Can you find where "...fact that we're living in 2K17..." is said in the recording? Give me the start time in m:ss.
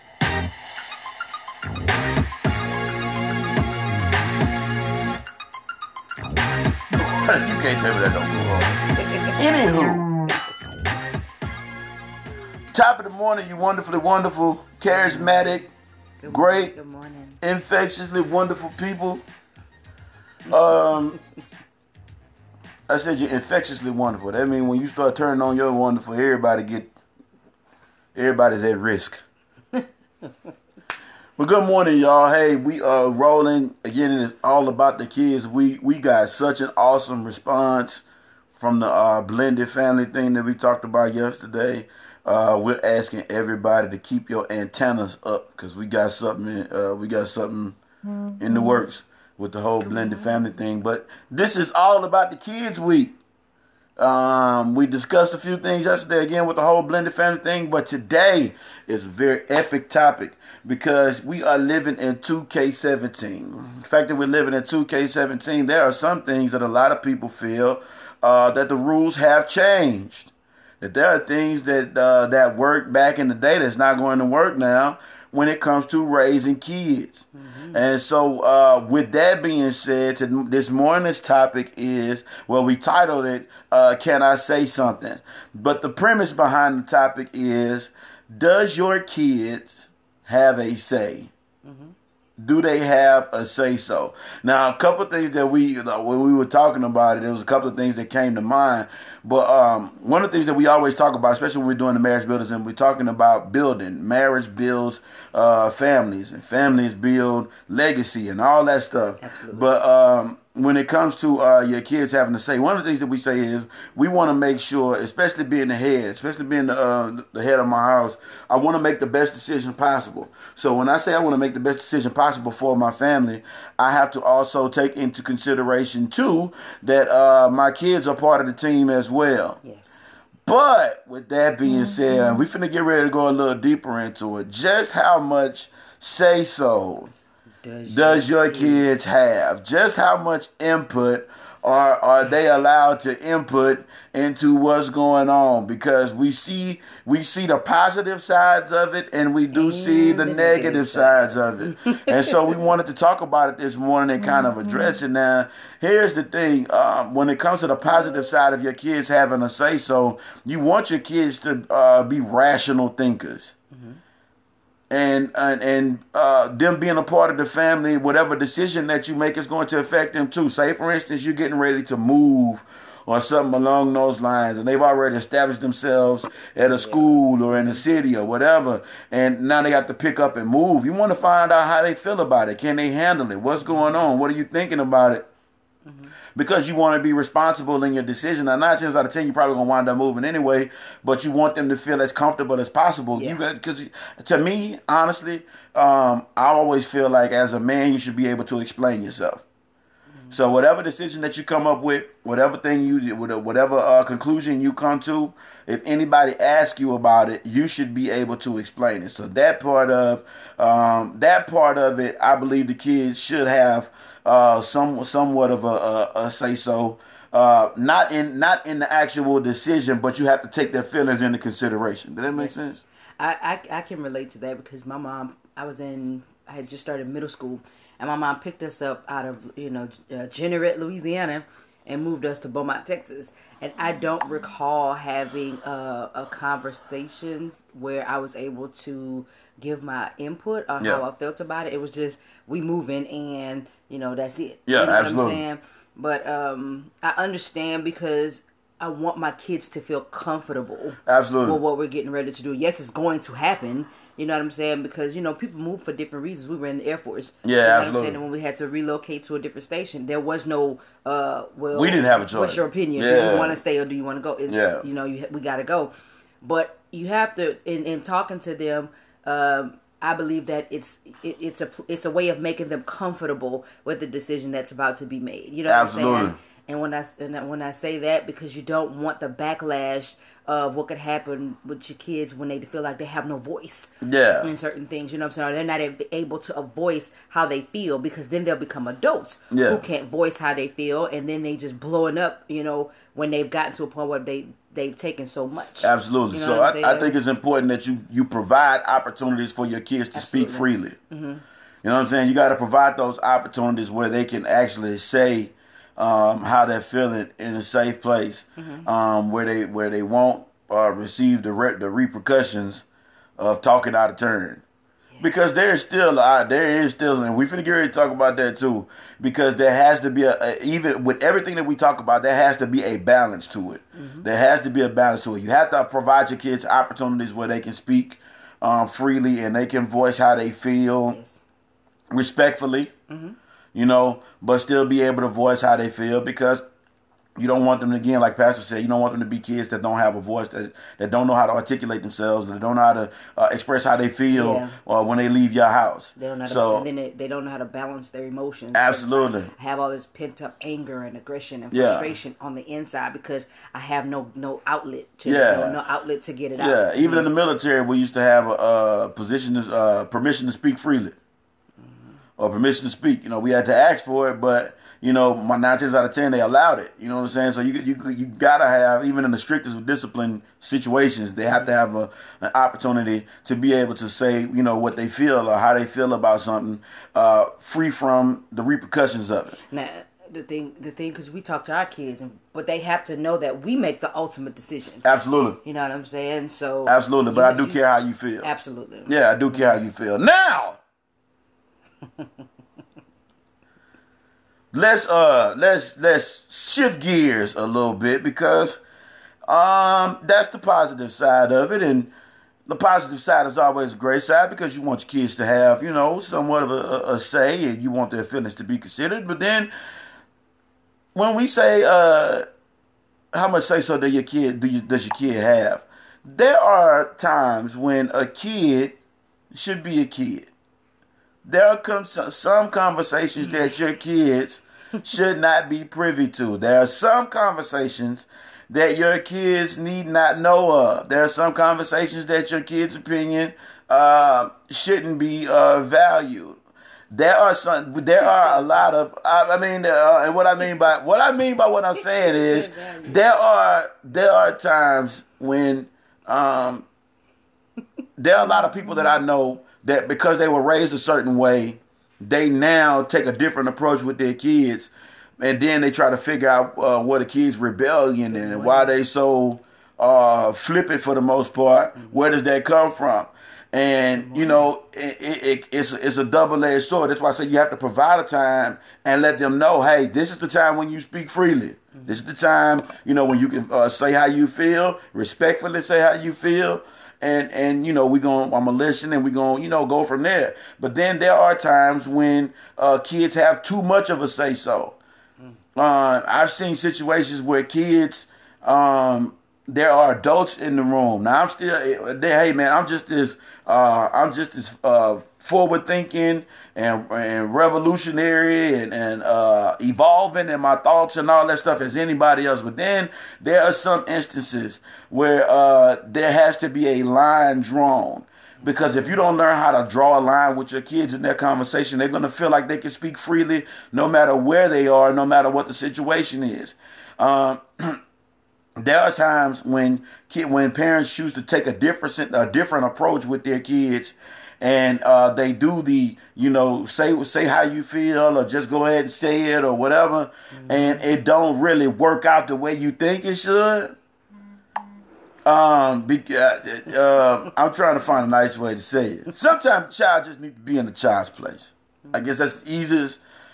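1:03.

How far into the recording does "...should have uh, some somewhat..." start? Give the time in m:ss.
3:33.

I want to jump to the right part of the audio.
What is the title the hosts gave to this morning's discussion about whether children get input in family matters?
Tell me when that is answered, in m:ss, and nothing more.
1:23.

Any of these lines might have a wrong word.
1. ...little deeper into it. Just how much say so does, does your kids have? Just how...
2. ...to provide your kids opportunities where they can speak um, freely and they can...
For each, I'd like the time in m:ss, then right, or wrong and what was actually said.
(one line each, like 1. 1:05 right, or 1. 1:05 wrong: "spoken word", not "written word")
1. 2:13 right
2. 5:25 right.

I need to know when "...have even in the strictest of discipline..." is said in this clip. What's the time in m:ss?
6:08.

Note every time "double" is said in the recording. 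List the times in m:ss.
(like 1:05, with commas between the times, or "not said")
7:46.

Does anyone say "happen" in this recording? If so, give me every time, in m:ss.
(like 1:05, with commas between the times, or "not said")
4:13, 4:40.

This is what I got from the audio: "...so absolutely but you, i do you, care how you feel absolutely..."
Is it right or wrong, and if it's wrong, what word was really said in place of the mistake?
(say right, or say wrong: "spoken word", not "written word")
right.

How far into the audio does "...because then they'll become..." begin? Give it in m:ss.
4:47.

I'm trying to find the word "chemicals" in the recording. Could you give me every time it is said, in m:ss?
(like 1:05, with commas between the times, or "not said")
not said.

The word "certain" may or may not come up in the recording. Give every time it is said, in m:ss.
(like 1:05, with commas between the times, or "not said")
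4:44, 7:30.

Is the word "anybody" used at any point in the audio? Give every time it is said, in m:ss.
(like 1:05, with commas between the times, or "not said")
3:25, 8:21.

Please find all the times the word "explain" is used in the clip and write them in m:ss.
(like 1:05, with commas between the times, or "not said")
3:18, 3:28.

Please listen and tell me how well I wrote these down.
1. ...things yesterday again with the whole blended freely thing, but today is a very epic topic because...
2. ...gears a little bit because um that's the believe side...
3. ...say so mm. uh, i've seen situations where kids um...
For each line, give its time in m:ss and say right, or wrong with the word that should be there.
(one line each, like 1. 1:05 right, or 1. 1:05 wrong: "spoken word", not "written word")
1. 0:55 wrong: "family", not "freely"
2. 6:36 wrong: "positive", not "believe"
3. 8:04 right.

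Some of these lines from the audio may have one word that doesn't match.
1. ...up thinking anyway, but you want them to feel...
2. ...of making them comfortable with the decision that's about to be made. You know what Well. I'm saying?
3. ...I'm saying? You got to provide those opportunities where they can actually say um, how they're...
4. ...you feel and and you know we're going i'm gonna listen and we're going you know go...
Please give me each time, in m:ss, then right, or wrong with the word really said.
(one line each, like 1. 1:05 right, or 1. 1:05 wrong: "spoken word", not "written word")
1. 3:09 wrong: "moving", not "thinking"
2. 4:32 wrong: "Absolutely", not "Well"
3. 5:02 right
4. 7:56 right.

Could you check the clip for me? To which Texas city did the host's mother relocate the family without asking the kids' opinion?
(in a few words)
Beaumont.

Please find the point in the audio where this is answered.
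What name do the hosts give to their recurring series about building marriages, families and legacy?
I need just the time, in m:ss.
1:41.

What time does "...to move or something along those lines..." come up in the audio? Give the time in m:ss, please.
2:51.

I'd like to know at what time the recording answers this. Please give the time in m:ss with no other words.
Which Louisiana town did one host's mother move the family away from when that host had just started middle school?
3:50.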